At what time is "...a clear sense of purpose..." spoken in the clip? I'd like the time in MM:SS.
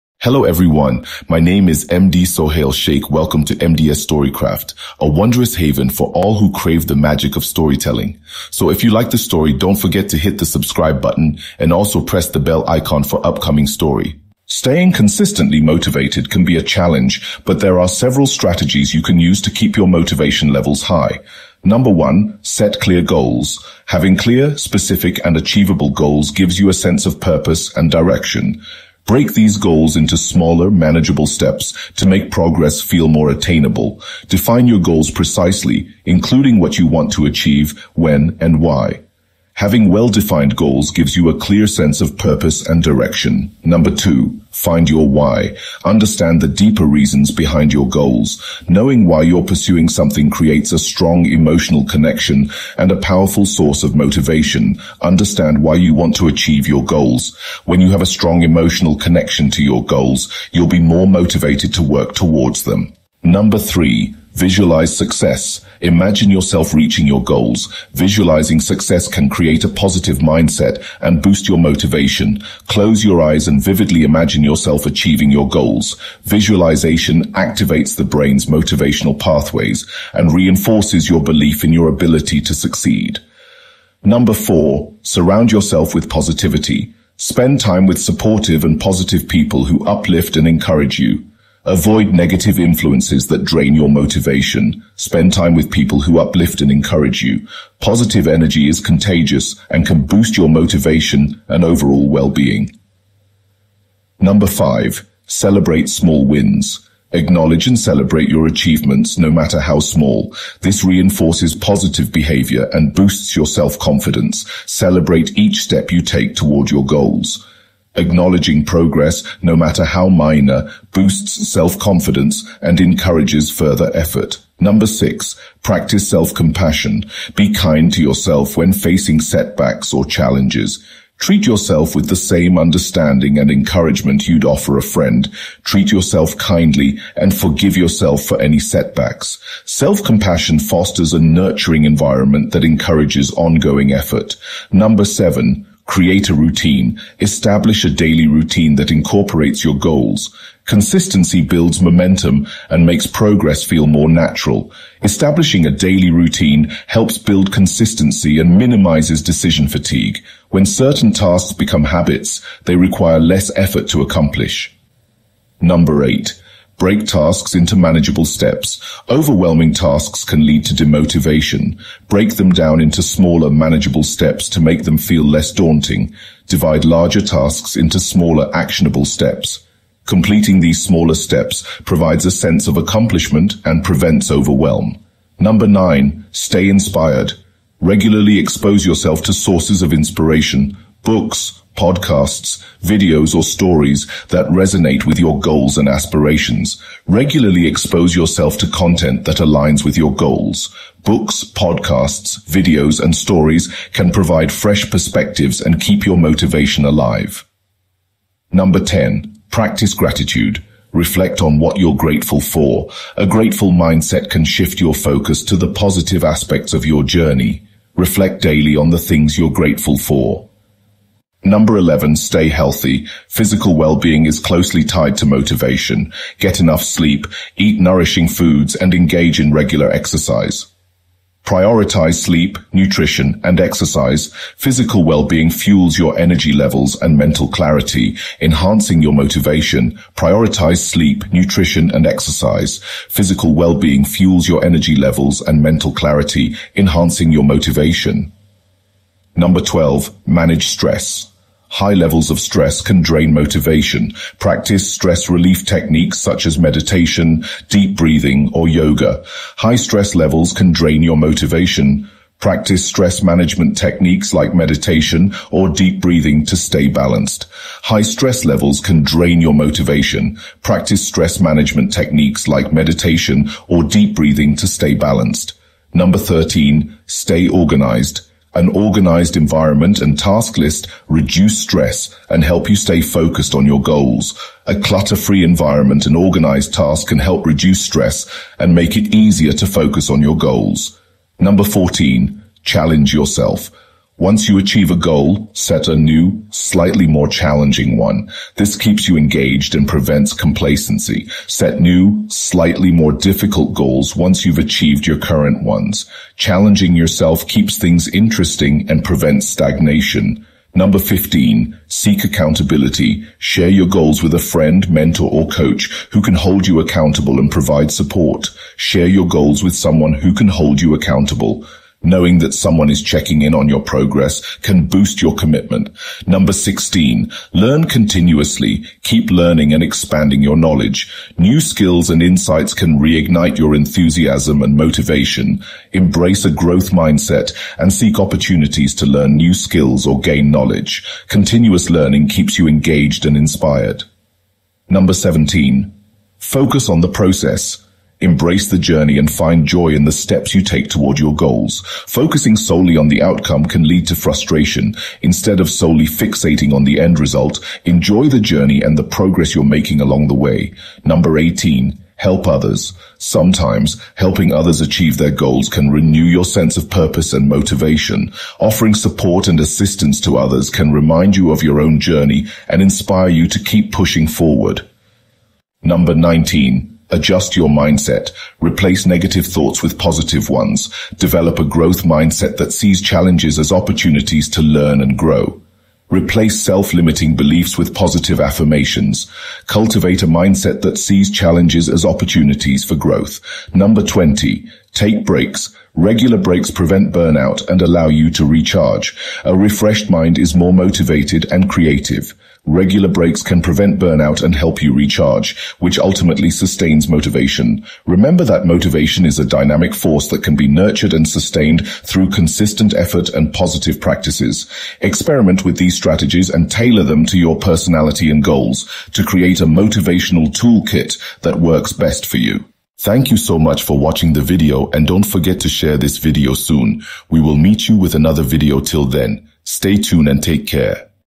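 00:41.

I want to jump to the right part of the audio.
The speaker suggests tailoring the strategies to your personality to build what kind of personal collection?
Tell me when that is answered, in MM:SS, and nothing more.
06:59.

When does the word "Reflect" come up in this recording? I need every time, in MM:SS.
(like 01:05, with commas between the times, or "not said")
03:30, 03:37.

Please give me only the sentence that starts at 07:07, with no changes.
We will meet you with another video till then.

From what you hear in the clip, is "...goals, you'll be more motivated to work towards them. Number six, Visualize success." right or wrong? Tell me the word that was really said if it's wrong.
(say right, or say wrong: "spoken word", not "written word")
wrong: "three", not "six".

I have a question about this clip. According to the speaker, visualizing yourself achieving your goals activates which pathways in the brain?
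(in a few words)
Motivational pathways.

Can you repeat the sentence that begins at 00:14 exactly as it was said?
Staying consistently motivated can be a challenge, but there are several strategies you can use to keep your motivation levels high.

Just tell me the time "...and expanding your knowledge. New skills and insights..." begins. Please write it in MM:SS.
05:29.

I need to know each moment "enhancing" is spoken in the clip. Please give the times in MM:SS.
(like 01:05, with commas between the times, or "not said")
03:58, 04:06.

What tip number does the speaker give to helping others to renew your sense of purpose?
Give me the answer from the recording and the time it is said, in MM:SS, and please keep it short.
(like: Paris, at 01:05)
18, at 06:01.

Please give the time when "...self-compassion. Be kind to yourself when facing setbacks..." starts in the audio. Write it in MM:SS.
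02:06.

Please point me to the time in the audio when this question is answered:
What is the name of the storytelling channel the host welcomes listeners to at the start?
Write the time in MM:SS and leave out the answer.
00:03.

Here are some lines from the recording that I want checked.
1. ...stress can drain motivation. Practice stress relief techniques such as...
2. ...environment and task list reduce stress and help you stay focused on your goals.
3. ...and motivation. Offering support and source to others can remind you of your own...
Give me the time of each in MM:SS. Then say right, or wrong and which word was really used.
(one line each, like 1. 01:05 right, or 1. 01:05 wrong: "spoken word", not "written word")
1. 04:12 right
2. 04:39 right
3. 06:07 wrong: "assistance", not "source".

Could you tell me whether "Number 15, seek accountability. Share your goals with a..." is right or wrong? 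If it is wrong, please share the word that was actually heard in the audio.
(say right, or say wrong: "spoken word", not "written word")
right.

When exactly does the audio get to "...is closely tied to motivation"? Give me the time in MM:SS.
03:44.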